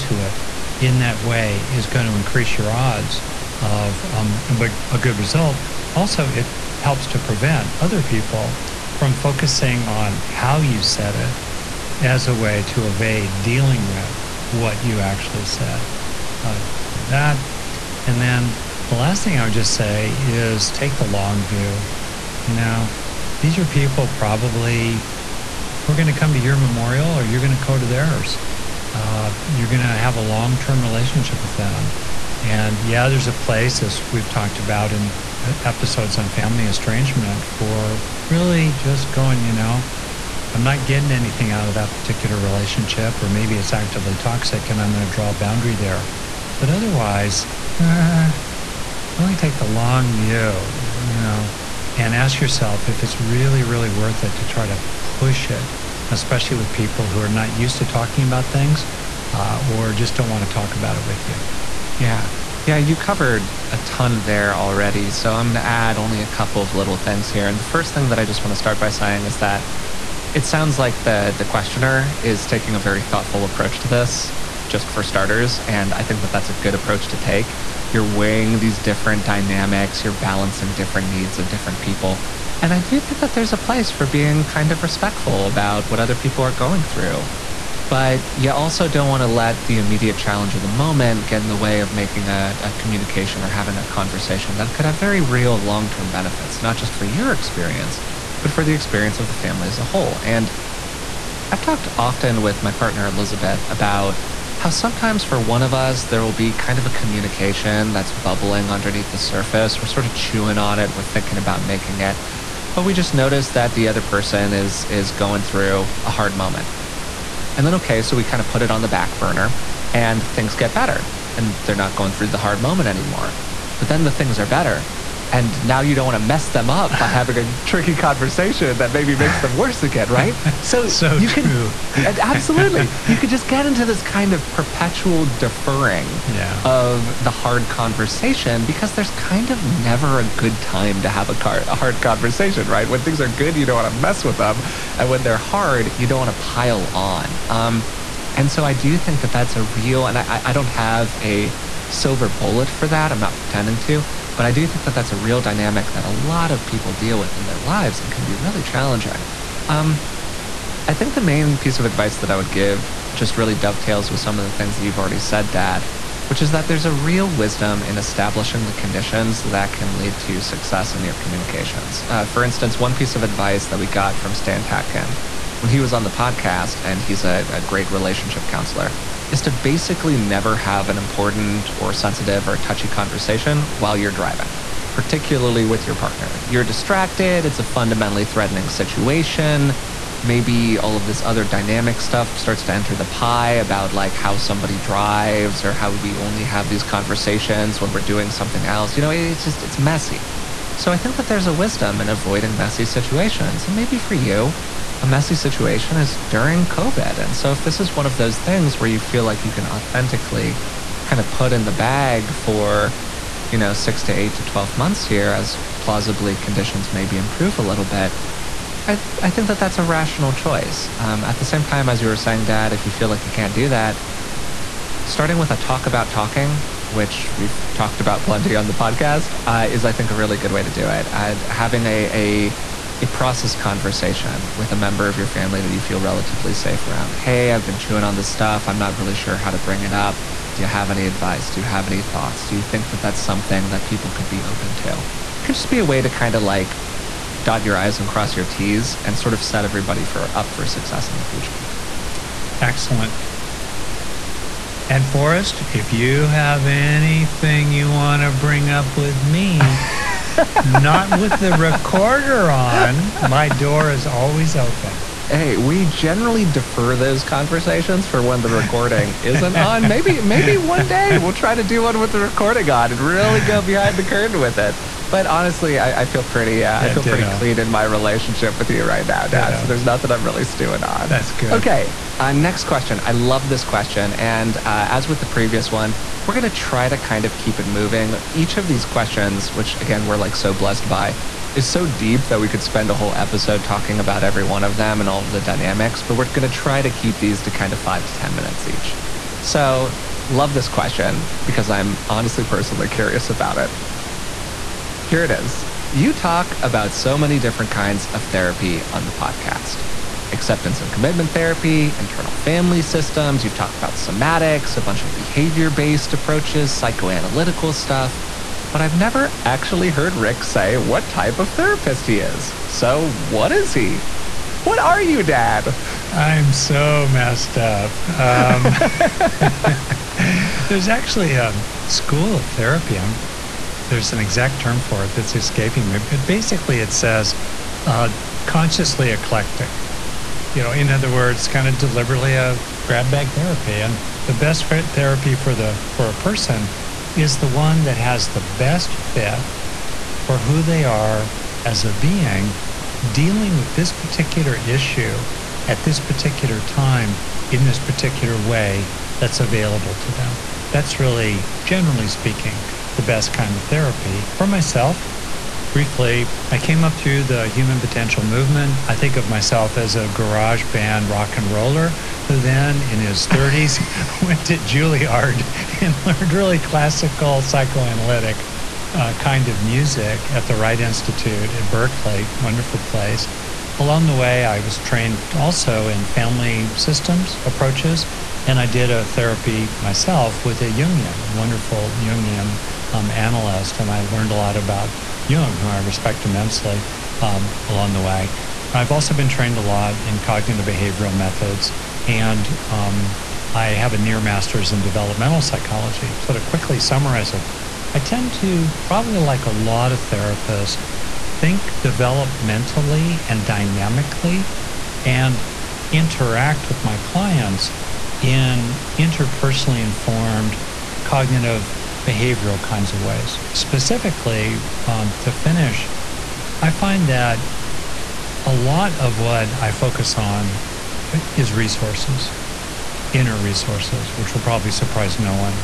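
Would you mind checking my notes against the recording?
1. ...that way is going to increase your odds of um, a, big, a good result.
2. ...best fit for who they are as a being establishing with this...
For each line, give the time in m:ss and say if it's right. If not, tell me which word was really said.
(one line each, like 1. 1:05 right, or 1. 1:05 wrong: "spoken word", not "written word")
1. 0:00 right
2. 5:48 wrong: "dealing", not "establishing".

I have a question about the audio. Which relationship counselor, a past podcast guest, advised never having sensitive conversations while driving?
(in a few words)
Stan Tatkin.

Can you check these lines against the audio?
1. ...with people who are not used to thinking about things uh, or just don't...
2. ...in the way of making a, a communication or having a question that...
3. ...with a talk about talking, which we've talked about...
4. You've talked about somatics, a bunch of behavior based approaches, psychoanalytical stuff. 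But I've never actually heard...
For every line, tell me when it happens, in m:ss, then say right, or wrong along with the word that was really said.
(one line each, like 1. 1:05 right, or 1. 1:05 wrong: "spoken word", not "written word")
1. 0:56 wrong: "talking", not "thinking"
2. 1:31 wrong: "conversation", not "question"
3. 3:45 right
4. 5:13 right.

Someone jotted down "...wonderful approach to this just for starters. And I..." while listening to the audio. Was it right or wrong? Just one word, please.
wrong.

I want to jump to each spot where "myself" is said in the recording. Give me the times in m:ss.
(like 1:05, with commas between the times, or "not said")
6:04, 6:09, 6:29.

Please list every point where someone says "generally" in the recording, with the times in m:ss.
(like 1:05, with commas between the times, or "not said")
4:25, 6:01.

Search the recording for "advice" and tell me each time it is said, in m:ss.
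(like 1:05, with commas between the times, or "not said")
2:41, 2:53, 4:01.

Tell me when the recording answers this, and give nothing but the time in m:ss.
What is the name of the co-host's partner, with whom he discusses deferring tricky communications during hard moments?
1:43.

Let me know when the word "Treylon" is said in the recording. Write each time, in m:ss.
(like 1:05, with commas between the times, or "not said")
not said.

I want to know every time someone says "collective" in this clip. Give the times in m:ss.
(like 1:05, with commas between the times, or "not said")
not said.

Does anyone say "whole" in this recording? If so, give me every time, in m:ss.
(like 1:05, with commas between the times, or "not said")
1:39, 4:52.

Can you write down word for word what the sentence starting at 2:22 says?
When things are good, you don't want to mess with them, and when they're hard, you don't want to pile on.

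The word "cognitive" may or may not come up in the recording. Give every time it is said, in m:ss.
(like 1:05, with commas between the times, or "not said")
6:40, 7:01.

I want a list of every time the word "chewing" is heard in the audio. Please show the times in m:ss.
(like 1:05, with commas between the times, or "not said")
1:50, 3:57.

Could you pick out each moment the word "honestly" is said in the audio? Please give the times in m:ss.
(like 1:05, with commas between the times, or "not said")
4:35, 5:02.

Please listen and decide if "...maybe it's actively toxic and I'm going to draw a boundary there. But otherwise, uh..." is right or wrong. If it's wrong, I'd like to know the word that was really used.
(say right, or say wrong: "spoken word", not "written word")
right.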